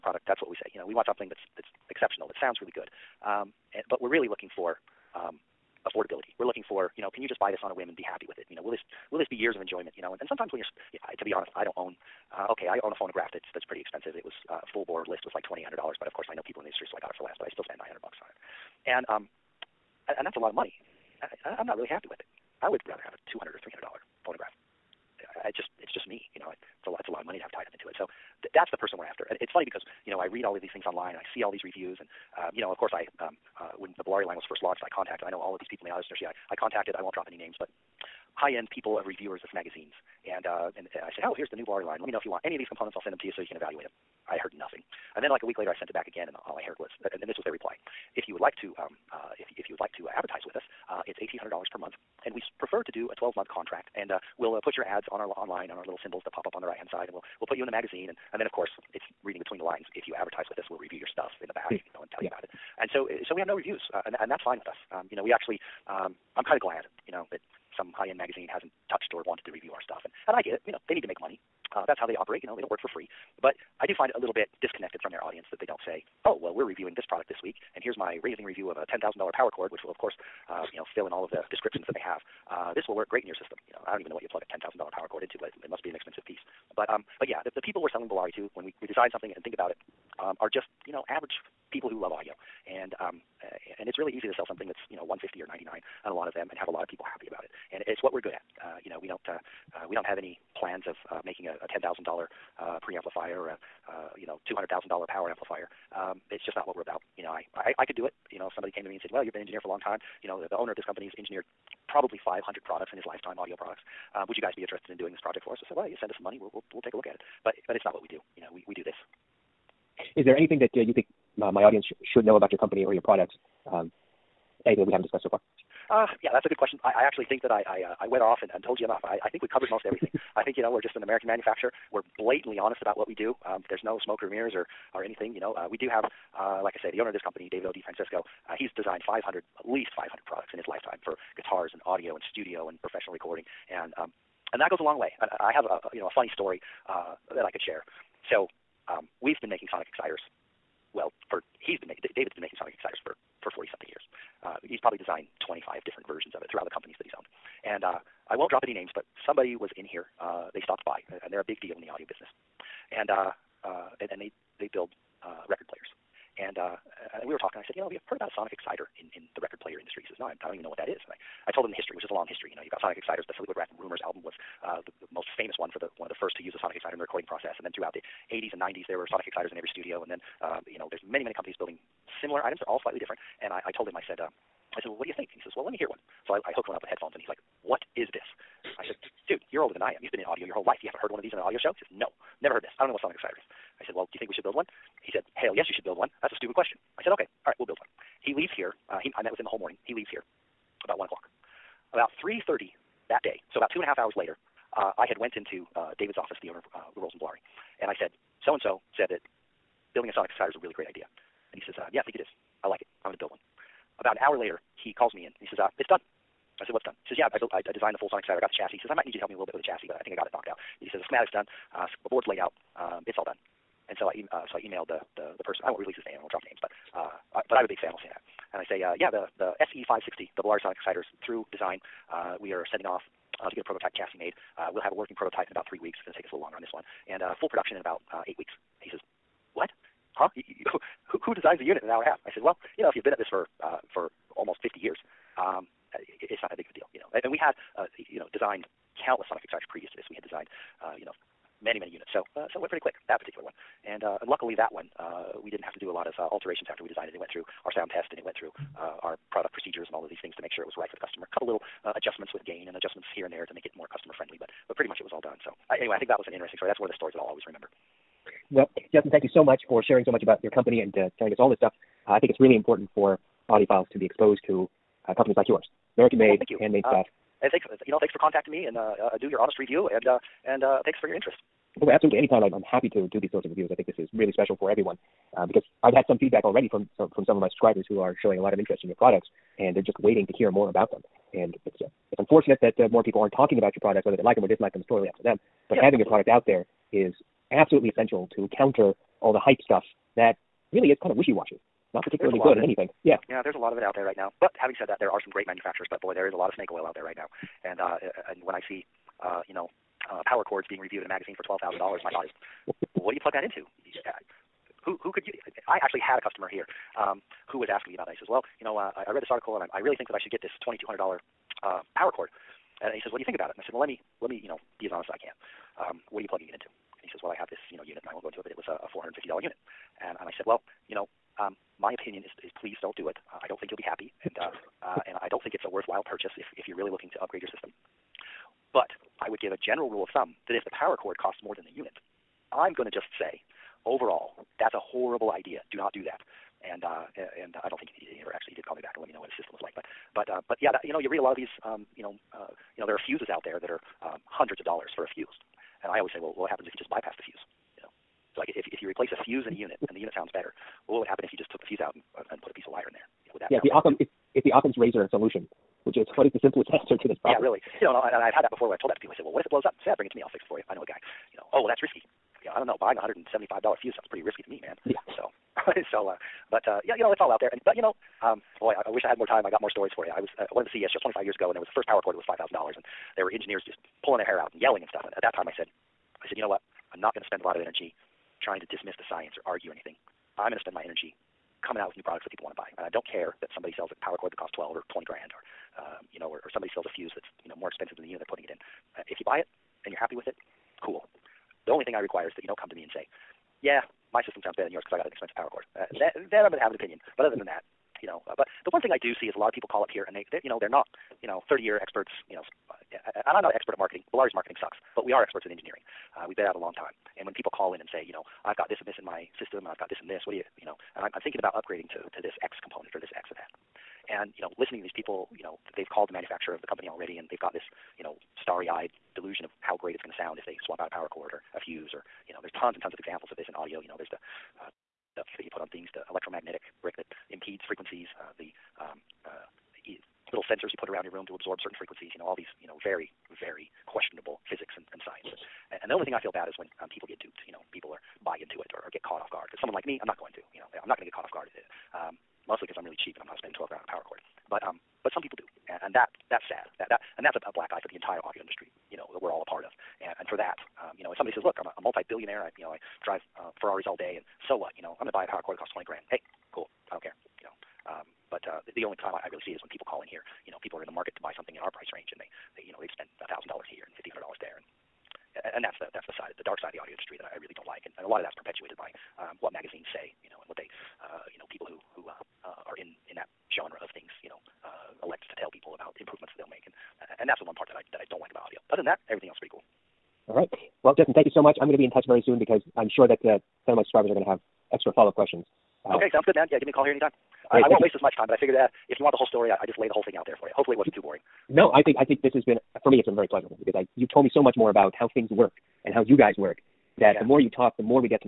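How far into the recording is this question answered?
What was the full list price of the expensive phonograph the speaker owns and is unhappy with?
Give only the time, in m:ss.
0:15.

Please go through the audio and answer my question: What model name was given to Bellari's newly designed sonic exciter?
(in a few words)
SE 560.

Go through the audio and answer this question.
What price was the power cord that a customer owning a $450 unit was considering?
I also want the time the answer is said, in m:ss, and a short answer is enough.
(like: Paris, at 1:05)
$2,200, at 5:20.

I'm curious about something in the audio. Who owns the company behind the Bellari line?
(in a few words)
David O. DiFrancesco.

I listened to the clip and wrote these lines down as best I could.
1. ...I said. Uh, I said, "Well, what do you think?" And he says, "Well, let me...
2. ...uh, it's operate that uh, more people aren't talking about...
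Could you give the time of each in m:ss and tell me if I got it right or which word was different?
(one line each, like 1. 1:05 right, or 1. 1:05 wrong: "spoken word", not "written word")
1. 3:03 right
2. 4:51 wrong: "unfortunate", not "operate".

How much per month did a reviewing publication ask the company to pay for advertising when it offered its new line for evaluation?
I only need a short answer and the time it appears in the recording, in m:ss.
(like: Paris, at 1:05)
$1,800, at 0:51.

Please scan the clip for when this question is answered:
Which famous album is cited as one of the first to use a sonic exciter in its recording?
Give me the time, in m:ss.
2:53.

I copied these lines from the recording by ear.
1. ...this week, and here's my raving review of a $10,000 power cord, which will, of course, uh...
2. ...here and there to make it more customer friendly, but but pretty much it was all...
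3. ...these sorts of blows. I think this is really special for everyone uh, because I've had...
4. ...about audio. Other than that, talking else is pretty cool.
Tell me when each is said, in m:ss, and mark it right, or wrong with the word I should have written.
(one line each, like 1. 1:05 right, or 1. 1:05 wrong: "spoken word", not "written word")
1. 1:17 right
2. 4:23 right
3. 4:43 wrong: "reviews", not "blows"
4. 8:08 wrong: "everything", not "talking".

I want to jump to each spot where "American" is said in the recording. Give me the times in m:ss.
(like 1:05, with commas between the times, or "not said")
2:11, 4:35.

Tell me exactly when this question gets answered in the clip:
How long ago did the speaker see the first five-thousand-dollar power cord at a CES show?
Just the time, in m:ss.
6:21.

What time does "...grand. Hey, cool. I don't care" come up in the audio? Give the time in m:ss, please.
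7:45.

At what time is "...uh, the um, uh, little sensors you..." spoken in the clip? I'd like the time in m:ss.
7:18.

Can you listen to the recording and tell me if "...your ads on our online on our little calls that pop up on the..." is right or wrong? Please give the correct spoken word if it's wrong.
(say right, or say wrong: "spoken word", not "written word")
wrong: "symbols", not "calls".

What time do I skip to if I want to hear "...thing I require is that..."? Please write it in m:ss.
6:41.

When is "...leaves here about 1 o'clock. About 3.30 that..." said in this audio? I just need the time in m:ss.
3:19.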